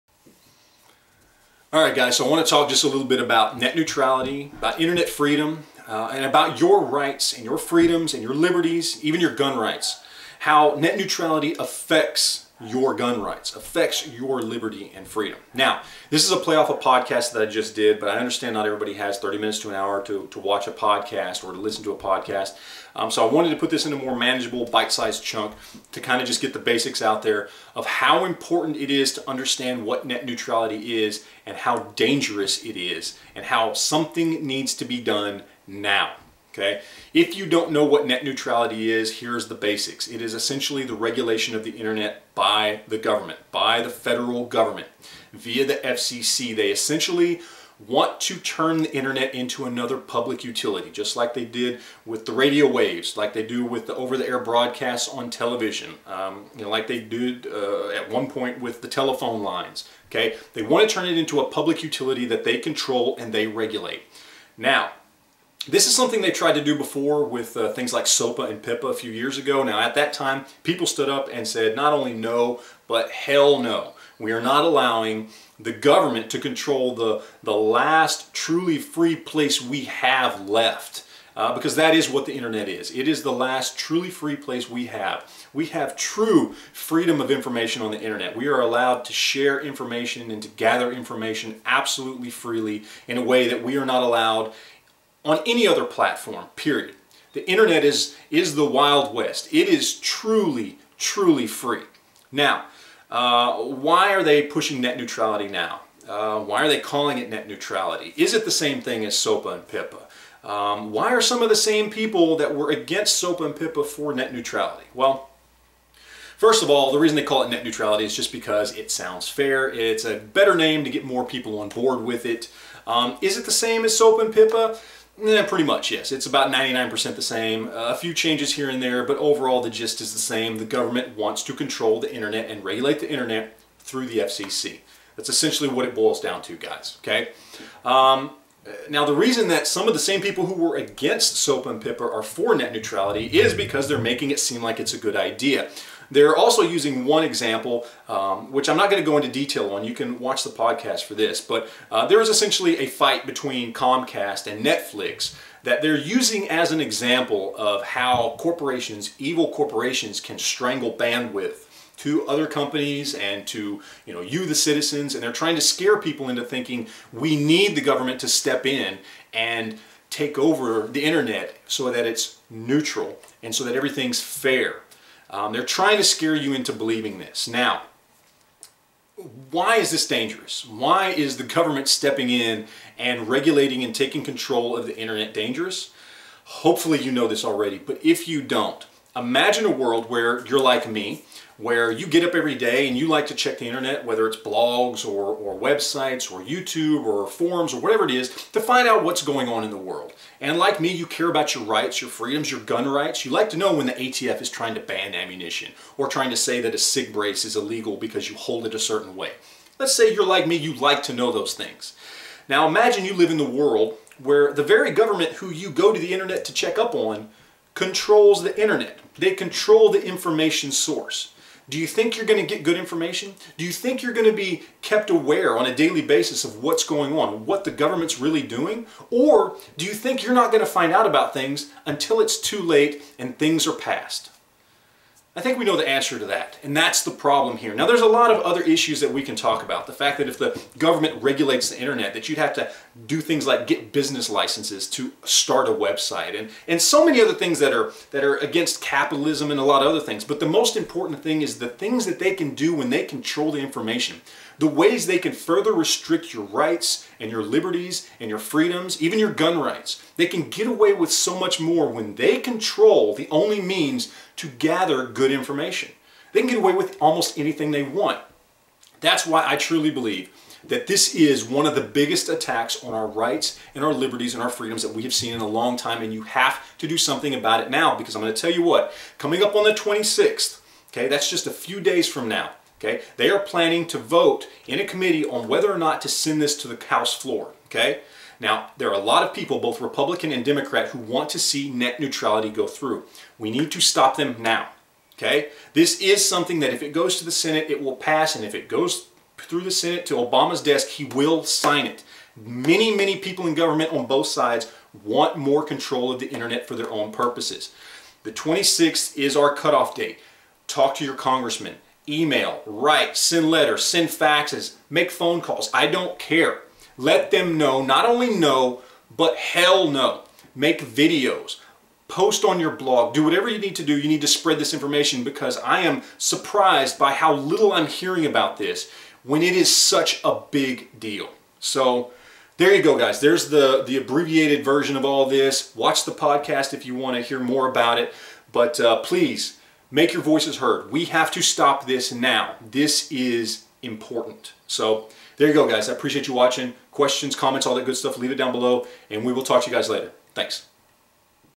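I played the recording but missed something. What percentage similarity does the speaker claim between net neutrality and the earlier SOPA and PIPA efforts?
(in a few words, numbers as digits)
99%.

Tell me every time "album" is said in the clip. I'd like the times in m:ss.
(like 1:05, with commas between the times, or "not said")
not said.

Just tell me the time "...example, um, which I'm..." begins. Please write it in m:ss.
2:27.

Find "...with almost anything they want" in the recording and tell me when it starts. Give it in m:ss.
4:26.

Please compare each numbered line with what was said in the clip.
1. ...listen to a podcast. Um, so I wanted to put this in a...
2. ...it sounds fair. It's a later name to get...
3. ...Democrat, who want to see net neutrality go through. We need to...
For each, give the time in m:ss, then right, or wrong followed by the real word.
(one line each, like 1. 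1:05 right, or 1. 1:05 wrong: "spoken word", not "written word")
1. 0:21 right
2. 1:58 wrong: "better", not "later"
3. 4:50 right.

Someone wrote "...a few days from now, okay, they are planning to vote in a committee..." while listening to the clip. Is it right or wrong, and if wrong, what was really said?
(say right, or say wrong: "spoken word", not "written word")
right.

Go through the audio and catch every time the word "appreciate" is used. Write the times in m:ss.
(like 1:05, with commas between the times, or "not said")
5:45.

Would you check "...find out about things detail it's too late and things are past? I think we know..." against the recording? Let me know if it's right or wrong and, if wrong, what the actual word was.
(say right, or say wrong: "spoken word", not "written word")
wrong: "until", not "detail".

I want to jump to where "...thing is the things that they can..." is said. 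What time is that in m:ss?
4:11.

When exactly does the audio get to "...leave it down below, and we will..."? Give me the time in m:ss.
5:48.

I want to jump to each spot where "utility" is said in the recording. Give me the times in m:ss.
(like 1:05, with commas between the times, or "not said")
0:50, 1:01.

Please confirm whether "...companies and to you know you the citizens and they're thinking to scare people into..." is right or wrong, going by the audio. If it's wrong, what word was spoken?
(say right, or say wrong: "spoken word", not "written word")
wrong: "trying", not "thinking".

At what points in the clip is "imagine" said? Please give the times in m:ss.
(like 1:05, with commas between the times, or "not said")
3:09, 3:32.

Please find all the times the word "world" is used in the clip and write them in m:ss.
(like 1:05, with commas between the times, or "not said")
3:09, 3:19, 3:33.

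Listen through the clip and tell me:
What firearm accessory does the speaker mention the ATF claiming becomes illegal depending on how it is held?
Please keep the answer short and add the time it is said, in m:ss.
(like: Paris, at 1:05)
SIG brace, at 3:26.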